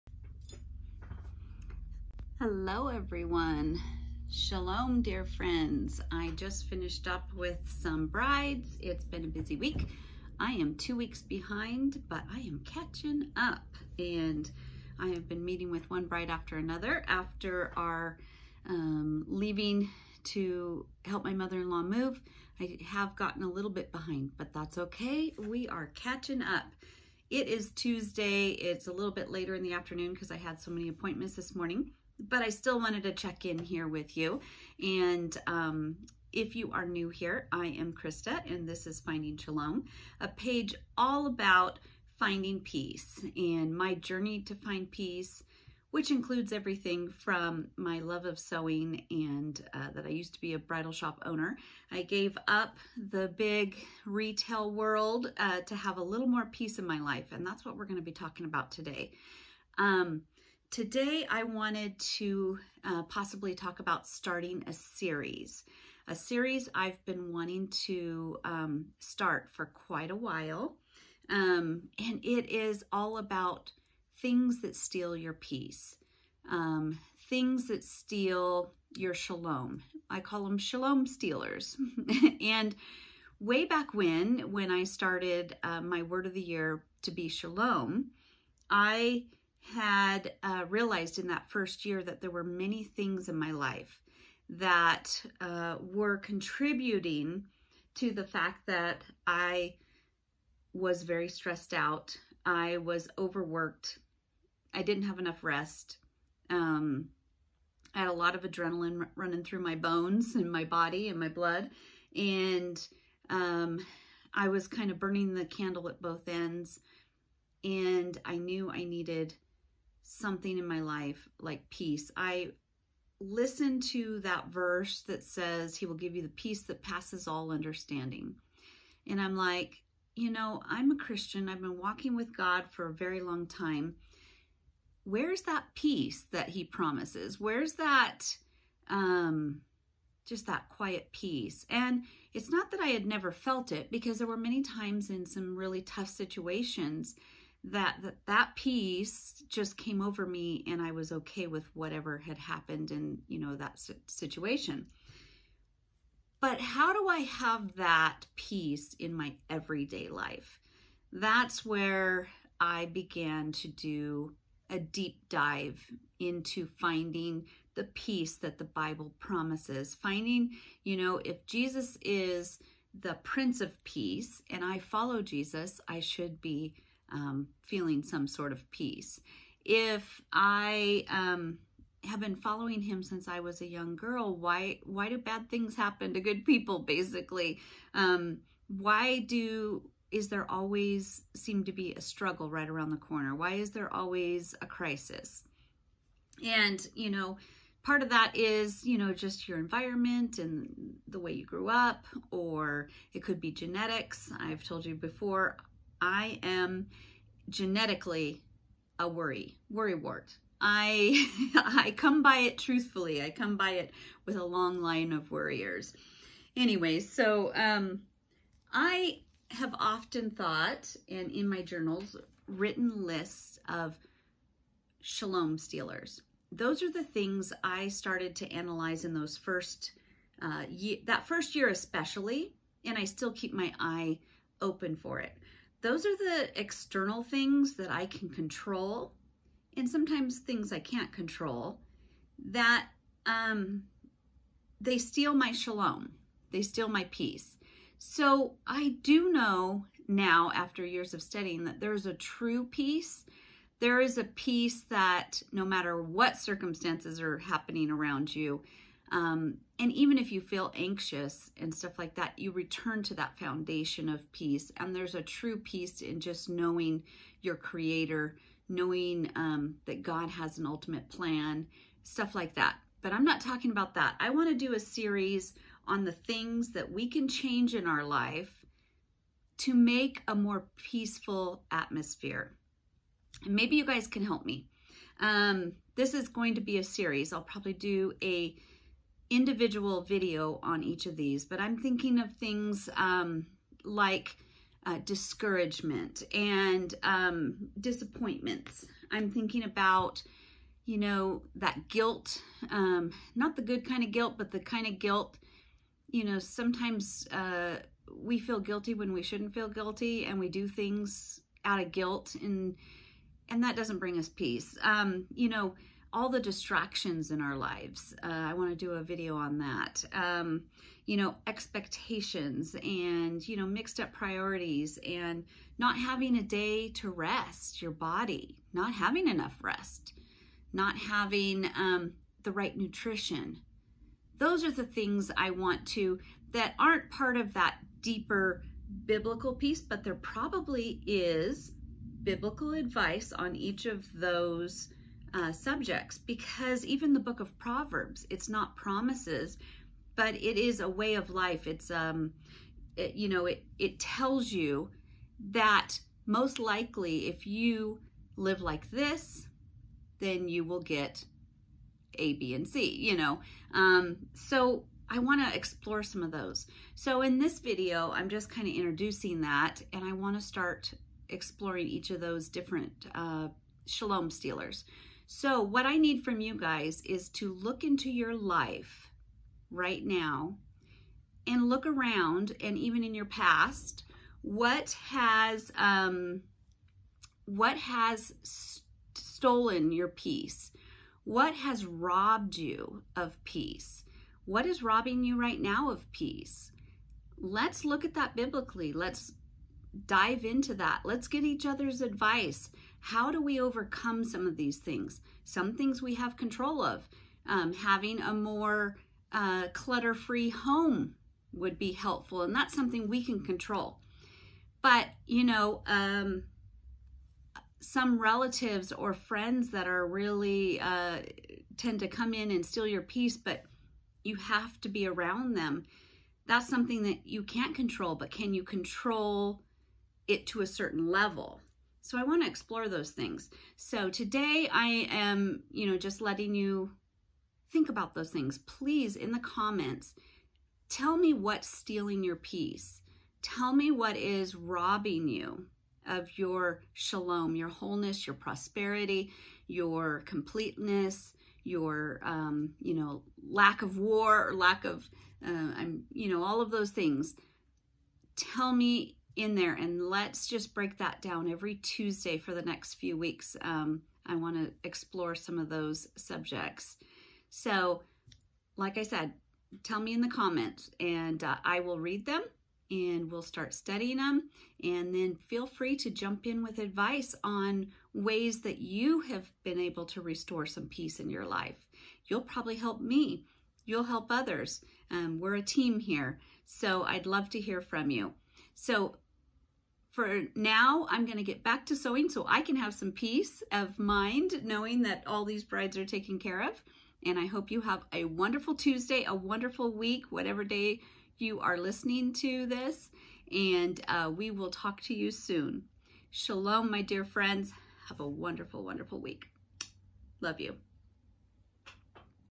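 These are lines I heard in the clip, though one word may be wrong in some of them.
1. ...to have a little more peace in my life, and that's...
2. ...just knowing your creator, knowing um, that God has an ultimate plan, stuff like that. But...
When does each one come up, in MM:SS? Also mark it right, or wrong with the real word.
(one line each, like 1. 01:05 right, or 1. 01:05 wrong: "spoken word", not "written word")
1. 00:55 right
2. 04:26 right.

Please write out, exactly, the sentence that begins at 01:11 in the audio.
Um, and it is all about things that steal your peace, um, things that steal your shalom.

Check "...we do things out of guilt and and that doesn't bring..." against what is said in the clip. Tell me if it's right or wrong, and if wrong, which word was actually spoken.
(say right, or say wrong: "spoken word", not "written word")
right.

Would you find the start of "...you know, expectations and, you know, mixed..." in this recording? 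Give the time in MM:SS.
05:21.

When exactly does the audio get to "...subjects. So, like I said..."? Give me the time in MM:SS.
07:46.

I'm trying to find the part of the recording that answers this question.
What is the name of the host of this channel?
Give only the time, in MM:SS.
00:37.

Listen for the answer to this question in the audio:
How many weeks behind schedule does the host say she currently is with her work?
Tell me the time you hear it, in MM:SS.
00:10.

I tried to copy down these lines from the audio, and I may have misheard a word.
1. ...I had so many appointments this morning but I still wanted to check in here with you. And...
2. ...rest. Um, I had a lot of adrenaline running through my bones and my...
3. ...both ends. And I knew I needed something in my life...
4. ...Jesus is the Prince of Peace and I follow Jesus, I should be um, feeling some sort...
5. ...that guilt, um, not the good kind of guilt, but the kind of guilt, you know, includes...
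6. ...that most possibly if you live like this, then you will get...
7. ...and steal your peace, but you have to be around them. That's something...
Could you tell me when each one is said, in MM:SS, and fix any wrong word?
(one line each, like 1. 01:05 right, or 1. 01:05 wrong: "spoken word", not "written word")
1. 00:30 right
2. 01:45 right
3. 01:56 right
4. 02:51 right
5. 05:01 wrong: "sometimes", not "includes"
6. 05:55 wrong: "likely", not "possibly"
7. 07:02 right.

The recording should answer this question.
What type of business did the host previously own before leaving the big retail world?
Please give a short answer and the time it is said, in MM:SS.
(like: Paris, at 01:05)
Bridal shop, at 00:50.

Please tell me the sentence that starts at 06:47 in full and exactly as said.
Um, having a more uh, clutter free home would be helpful, and that's something we can control.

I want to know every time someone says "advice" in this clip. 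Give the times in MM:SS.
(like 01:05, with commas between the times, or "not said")
05:42, 06:42, 07:56.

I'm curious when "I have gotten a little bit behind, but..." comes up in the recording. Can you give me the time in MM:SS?
00:22.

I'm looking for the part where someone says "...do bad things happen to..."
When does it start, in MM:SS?
03:05.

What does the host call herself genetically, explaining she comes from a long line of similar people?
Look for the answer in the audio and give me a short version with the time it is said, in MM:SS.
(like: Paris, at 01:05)
Worry wart, at 03:29.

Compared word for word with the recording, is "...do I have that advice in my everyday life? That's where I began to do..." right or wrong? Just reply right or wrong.
wrong.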